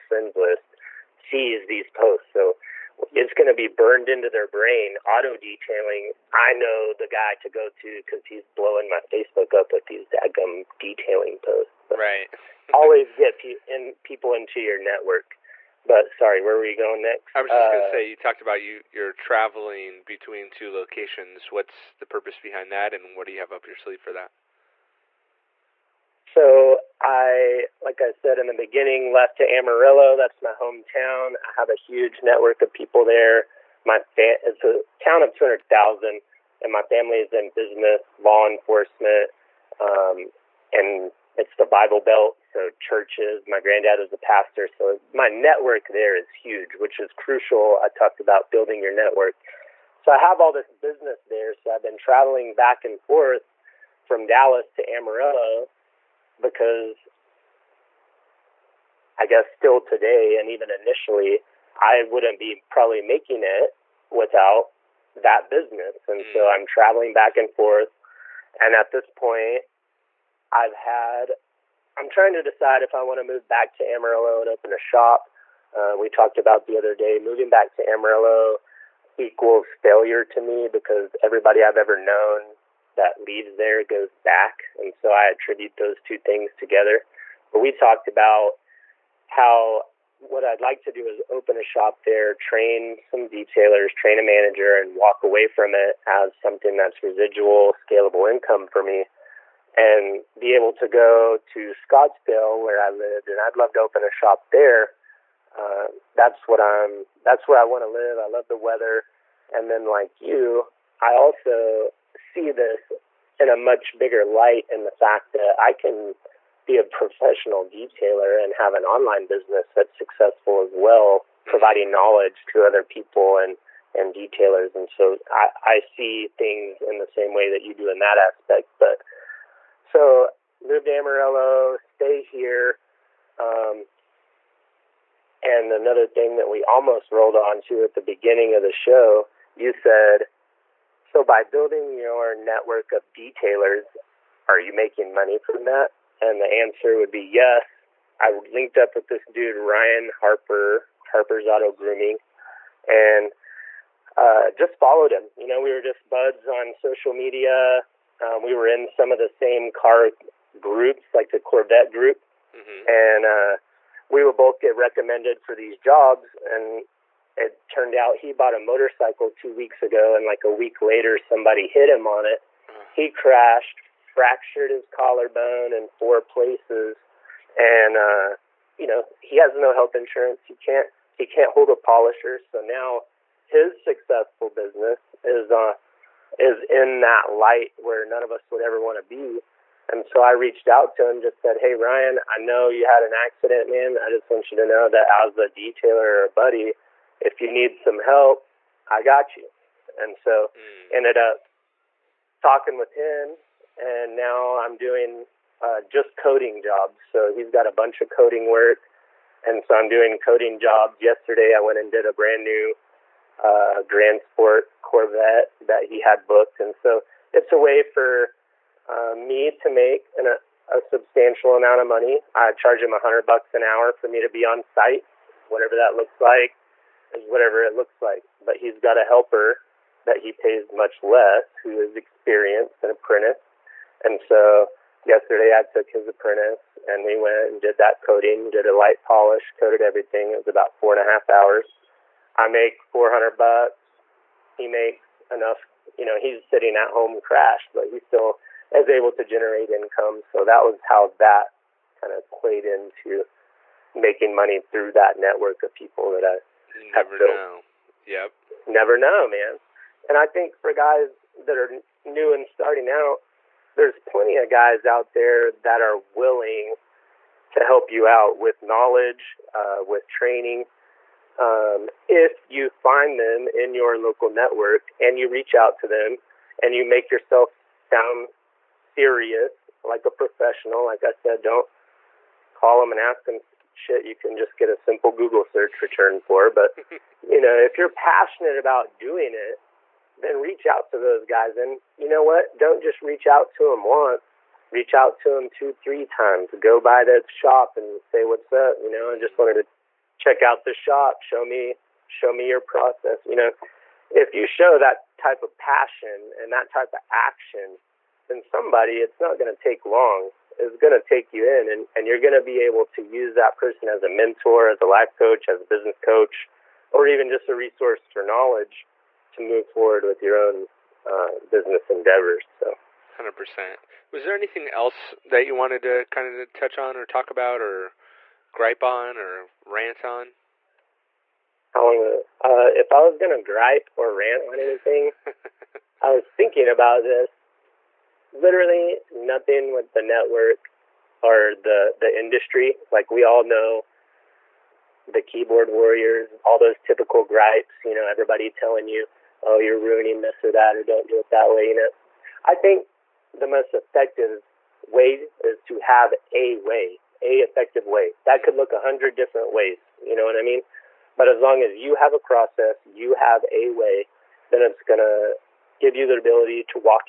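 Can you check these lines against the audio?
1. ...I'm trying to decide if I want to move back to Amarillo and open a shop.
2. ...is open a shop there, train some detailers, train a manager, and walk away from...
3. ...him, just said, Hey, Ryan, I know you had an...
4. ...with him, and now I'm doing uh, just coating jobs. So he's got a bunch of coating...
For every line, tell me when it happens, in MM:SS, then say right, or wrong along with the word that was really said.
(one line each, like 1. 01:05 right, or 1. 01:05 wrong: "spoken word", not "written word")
1. 01:11 right
2. 01:31 right
3. 03:11 right
4. 03:22 right.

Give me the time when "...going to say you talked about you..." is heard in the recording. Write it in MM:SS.
00:17.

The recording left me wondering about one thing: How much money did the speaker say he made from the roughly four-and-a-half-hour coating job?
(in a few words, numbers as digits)
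$400.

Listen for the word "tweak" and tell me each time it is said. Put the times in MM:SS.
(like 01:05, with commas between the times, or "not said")
not said.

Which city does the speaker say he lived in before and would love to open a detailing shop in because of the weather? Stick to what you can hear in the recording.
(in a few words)
Scottsdale.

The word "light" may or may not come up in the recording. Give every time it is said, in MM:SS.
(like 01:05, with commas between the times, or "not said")
01:54, 03:07, 03:58.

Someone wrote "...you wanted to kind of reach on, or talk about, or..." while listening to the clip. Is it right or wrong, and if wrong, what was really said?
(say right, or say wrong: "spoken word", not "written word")
wrong: "touch", not "reach".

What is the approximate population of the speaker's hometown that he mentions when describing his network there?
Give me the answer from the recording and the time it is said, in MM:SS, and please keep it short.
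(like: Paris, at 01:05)
200,000, at 00:35.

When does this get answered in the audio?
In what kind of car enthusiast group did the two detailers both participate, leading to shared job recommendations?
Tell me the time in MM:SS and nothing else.
02:41.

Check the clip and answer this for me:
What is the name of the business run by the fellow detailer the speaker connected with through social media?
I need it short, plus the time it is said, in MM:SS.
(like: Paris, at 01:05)
Harper's Auto Grooming, at 02:31.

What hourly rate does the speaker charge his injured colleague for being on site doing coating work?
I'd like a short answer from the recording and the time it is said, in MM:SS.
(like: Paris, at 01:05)
$100, at 03:42.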